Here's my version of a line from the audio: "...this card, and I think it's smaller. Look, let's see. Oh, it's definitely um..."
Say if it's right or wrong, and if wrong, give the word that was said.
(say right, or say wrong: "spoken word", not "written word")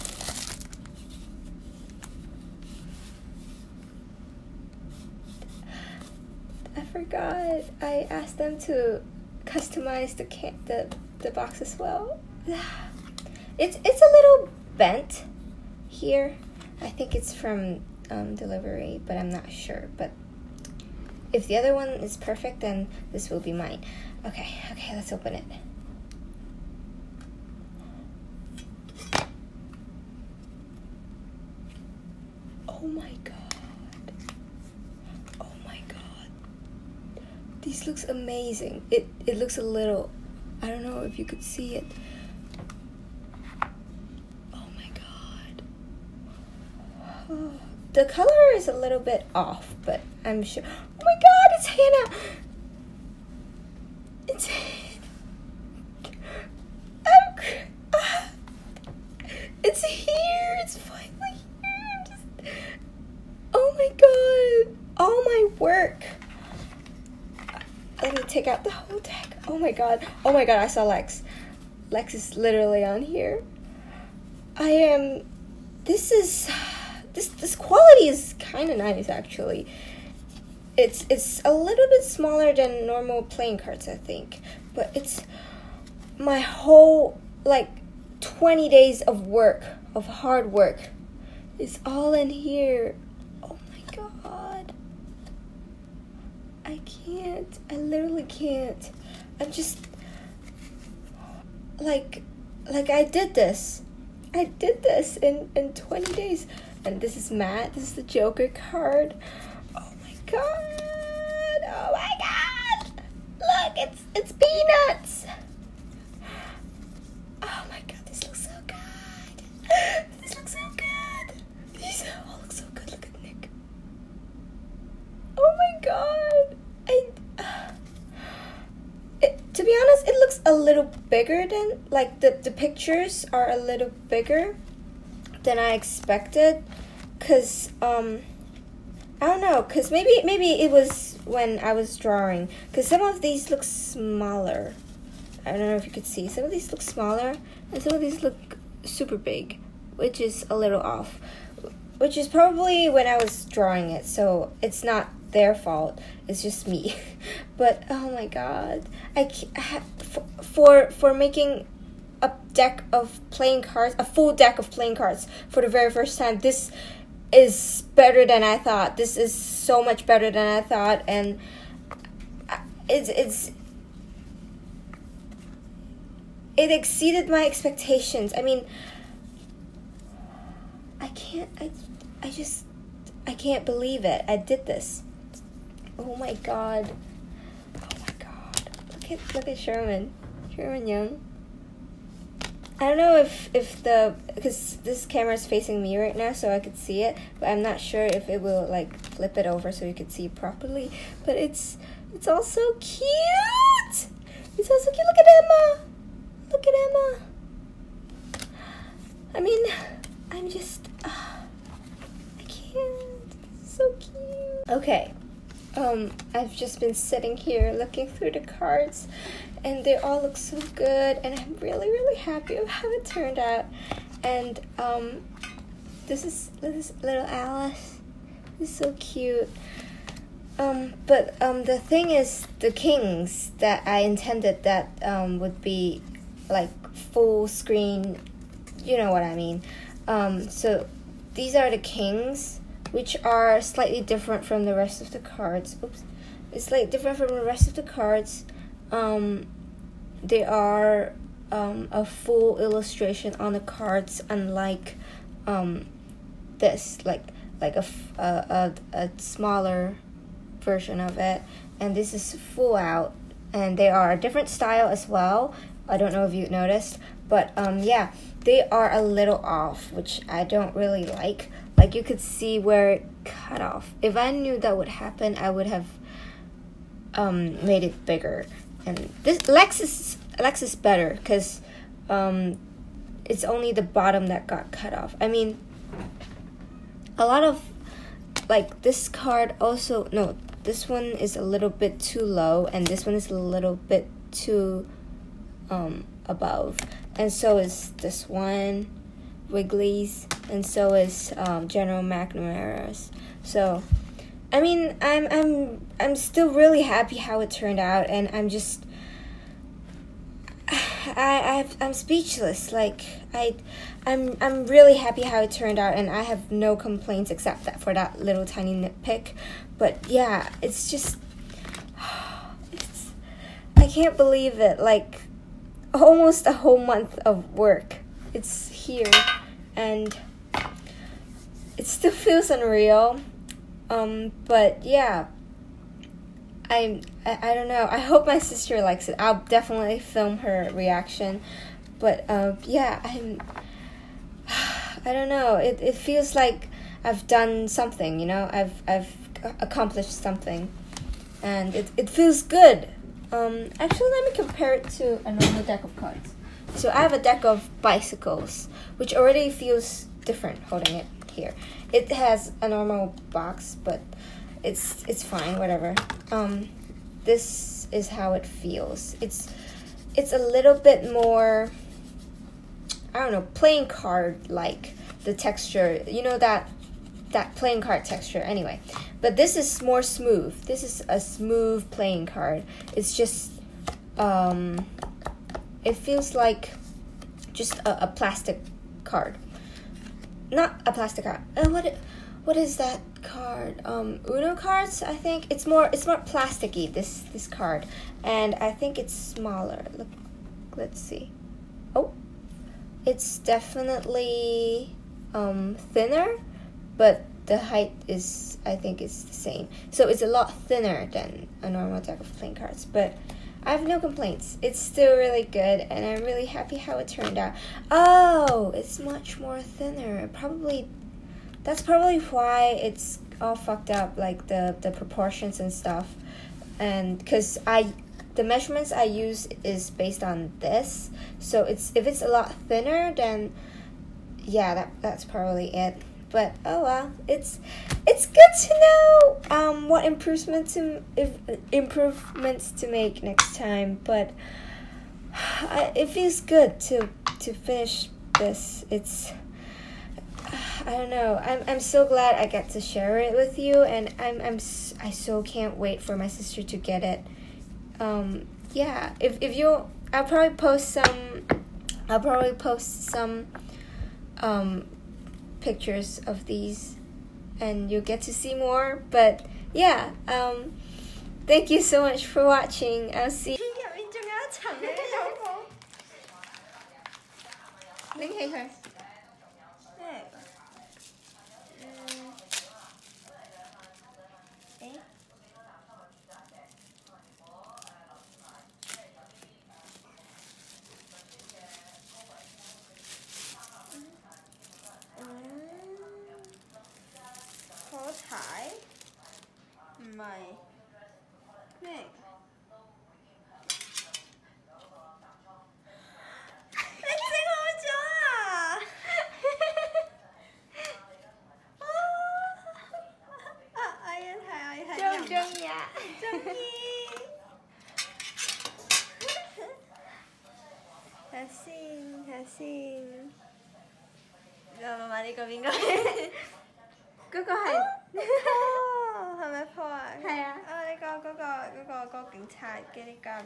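right.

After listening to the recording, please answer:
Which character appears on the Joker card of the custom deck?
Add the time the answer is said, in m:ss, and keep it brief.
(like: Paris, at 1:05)
Peanuts, at 1:54.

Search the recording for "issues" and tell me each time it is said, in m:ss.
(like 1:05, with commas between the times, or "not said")
not said.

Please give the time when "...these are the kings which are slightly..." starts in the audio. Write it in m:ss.
4:01.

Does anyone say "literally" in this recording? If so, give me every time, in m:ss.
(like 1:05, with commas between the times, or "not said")
1:12, 1:37.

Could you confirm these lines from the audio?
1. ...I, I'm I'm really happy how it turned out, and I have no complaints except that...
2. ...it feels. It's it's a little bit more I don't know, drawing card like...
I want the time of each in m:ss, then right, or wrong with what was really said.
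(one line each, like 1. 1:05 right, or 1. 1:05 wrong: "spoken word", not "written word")
1. 5:13 right
2. 6:08 wrong: "playing", not "drawing".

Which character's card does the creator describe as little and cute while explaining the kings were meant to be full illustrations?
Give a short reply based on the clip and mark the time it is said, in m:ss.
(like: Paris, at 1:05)
Alice, at 3:47.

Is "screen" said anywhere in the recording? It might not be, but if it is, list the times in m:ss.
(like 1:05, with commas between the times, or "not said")
3:57.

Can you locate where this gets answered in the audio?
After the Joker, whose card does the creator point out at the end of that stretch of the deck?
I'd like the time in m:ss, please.
2:03.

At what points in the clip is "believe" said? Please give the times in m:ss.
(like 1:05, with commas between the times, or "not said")
3:03, 5:24.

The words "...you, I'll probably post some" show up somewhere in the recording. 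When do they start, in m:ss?
7:39.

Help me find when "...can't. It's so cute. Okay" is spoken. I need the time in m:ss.
3:32.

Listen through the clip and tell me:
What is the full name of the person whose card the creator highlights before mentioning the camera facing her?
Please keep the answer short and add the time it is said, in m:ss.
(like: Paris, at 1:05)
Sherman Young, at 3:10.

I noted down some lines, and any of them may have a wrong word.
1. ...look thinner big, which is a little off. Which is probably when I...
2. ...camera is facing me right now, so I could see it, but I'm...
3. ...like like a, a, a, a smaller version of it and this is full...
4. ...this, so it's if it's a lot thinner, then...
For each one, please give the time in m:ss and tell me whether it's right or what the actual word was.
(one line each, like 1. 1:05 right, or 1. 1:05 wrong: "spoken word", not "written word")
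1. 2:28 wrong: "super", not "thinner"
2. 3:15 right
3. 4:17 right
4. 7:10 right.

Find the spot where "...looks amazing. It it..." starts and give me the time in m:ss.
0:37.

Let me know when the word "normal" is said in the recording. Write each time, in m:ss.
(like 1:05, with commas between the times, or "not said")
1:22, 5:55, 6:02, 6:51.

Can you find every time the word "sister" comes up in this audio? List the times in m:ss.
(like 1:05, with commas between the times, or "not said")
5:38, 7:36.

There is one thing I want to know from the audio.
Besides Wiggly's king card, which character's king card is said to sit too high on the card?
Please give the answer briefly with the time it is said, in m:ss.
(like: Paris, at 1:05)
General McNamara, at 5:01.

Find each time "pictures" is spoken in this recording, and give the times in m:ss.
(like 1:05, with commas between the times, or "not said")
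2:12, 7:45.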